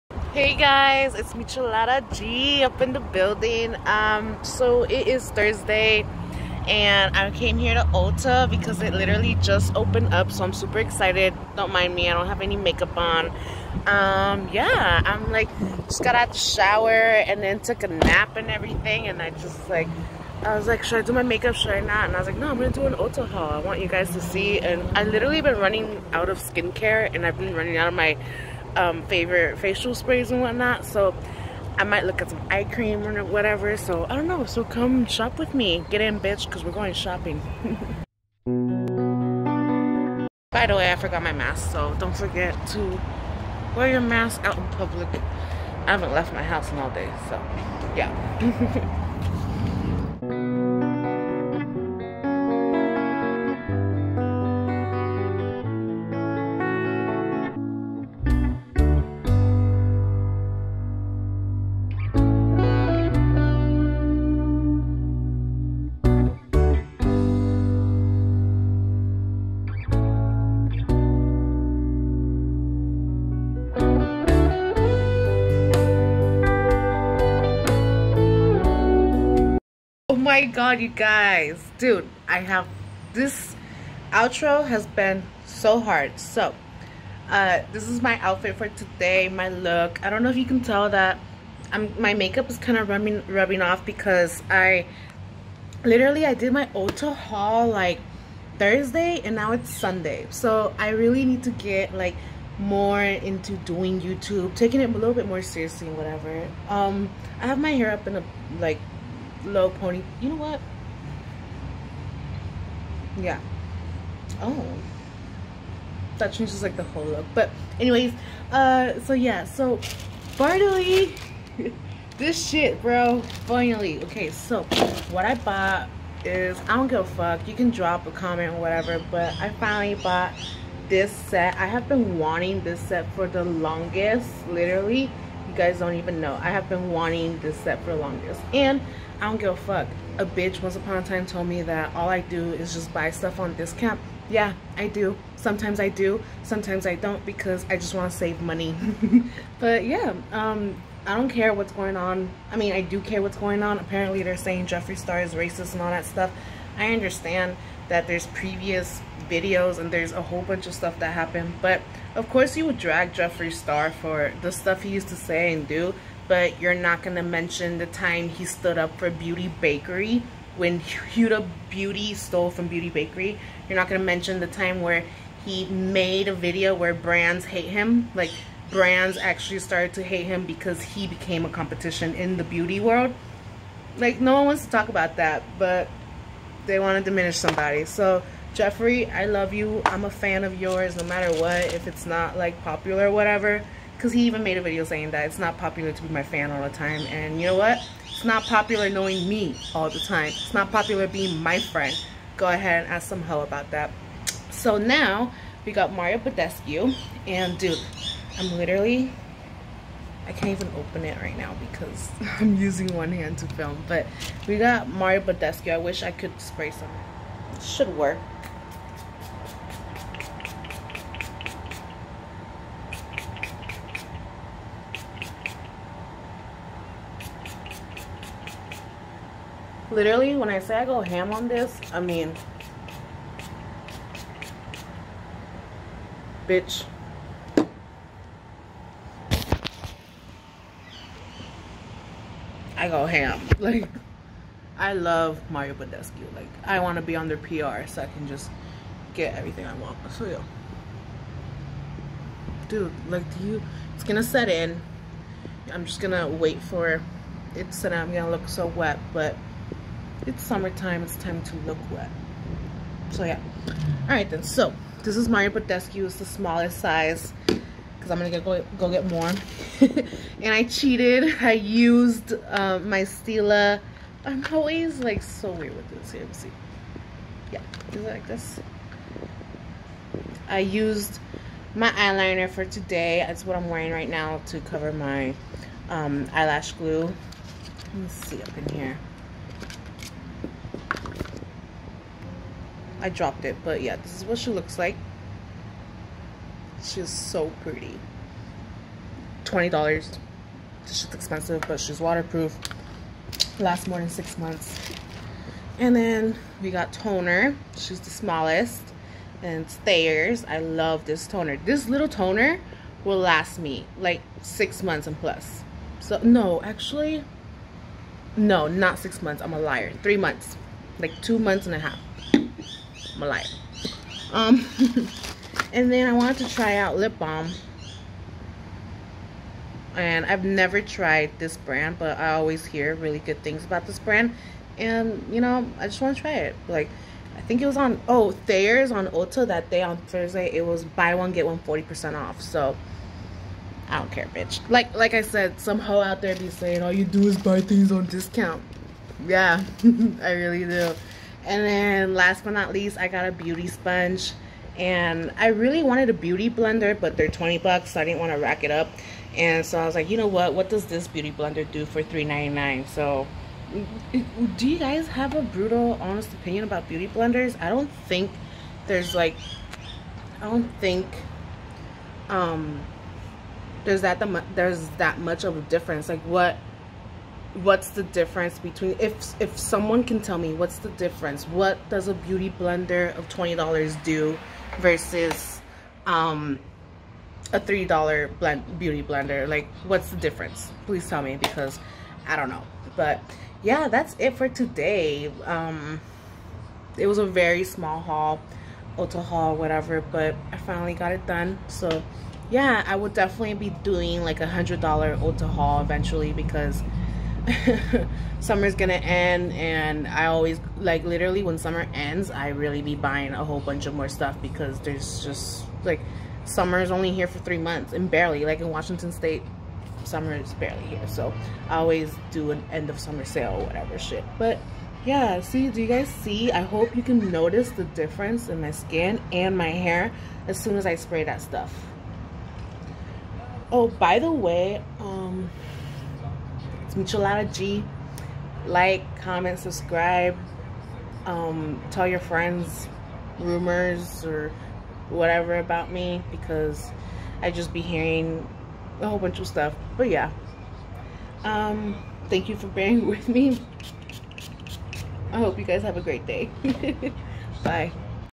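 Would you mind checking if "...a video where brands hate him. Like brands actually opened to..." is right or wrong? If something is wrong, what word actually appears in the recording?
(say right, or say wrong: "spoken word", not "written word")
wrong: "started", not "opened".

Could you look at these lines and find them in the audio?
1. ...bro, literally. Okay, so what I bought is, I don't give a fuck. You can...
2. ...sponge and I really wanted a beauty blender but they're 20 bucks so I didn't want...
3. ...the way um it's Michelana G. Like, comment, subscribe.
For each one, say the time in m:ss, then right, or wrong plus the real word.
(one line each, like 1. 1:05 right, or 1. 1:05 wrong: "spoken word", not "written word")
1. 2:02 wrong: "finally", not "literally"
2. 5:53 right
3. 7:14 right.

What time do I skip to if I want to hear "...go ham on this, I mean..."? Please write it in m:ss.
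3:50.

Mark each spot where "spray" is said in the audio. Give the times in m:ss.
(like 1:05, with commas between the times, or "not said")
0:29, 3:36, 7:10.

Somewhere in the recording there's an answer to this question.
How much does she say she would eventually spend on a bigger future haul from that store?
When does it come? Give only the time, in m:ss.
6:44.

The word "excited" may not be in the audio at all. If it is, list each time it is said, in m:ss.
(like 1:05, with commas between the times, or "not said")
0:10.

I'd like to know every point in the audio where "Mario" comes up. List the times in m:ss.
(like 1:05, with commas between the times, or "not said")
3:25, 3:34, 4:05, 4:25.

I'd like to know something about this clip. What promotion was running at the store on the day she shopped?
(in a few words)
Buy one get one 40% off.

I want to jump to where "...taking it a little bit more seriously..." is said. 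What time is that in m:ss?
1:44.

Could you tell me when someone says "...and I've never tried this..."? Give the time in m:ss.
5:29.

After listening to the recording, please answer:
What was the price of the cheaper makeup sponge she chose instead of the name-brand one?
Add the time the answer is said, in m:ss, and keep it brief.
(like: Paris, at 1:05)
$3.99, at 6:02.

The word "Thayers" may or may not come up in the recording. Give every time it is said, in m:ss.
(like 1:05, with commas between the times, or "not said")
5:09, 5:38.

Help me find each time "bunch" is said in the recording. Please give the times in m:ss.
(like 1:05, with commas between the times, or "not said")
2:40, 6:53, 7:29.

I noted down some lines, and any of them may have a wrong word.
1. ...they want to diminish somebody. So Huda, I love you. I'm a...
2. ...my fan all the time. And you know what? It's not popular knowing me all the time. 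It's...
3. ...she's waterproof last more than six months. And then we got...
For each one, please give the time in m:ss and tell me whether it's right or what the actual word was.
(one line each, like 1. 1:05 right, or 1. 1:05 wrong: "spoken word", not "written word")
1. 3:06 wrong: "Jeffree", not "Huda"
2. 3:16 right
3. 5:01 right.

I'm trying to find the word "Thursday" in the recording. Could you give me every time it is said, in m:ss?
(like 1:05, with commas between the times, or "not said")
0:05, 1:38, 5:39.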